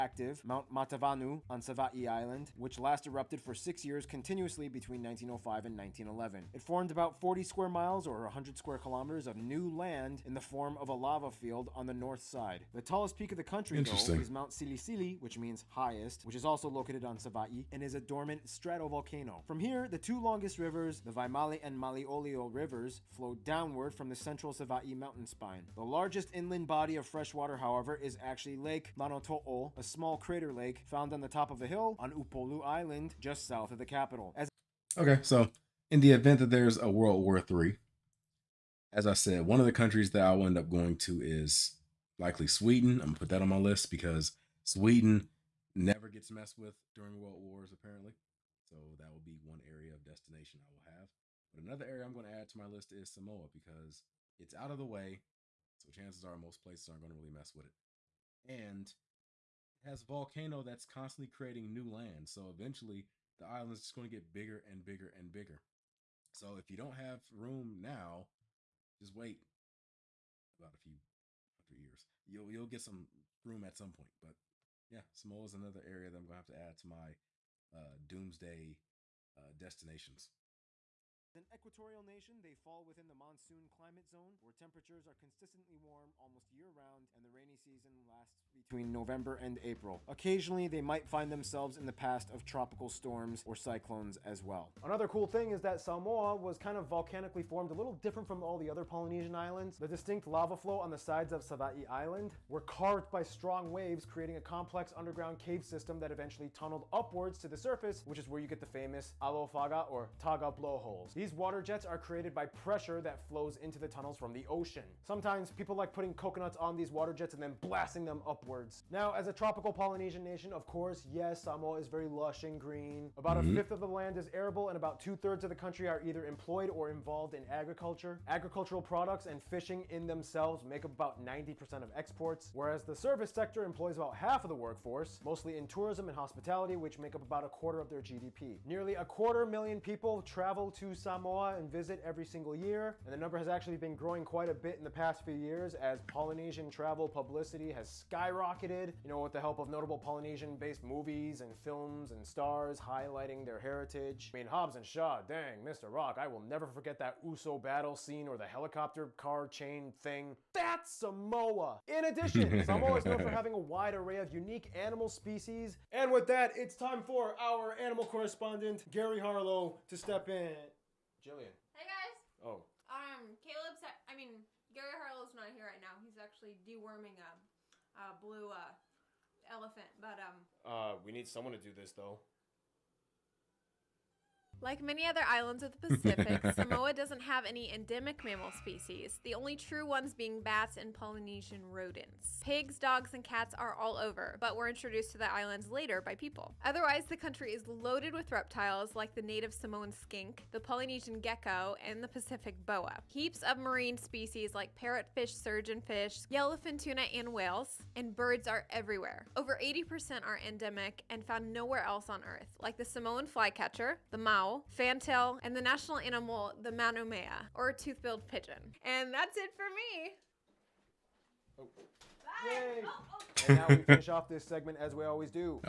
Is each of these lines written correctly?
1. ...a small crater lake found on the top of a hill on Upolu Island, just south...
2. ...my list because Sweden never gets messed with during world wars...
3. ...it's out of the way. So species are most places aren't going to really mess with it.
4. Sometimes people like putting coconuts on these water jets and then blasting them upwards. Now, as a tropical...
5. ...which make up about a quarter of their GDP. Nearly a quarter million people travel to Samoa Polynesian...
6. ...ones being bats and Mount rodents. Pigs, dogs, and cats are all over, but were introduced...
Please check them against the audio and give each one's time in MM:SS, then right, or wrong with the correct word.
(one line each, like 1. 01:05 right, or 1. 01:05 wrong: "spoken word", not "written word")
1. 00:29 right
2. 00:43 right
3. 00:54 wrong: "chances", not "species"
4. 01:55 right
5. 02:16 wrong: "Samoa", not "Polynesian"
6. 03:09 wrong: "Polynesian", not "Mount".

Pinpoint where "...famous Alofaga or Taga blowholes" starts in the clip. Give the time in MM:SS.
01:48.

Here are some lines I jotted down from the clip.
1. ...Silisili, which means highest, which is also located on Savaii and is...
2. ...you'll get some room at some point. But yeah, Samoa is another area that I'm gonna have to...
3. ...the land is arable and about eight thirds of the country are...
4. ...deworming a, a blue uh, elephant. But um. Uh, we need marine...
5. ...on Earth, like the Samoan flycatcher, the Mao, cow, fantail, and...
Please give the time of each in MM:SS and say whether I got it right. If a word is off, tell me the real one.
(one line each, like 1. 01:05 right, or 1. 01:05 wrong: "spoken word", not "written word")
1. 00:14 right
2. 01:12 right
3. 02:03 wrong: "two", not "eight"
4. 02:56 wrong: "someone", not "marine"
5. 03:32 right.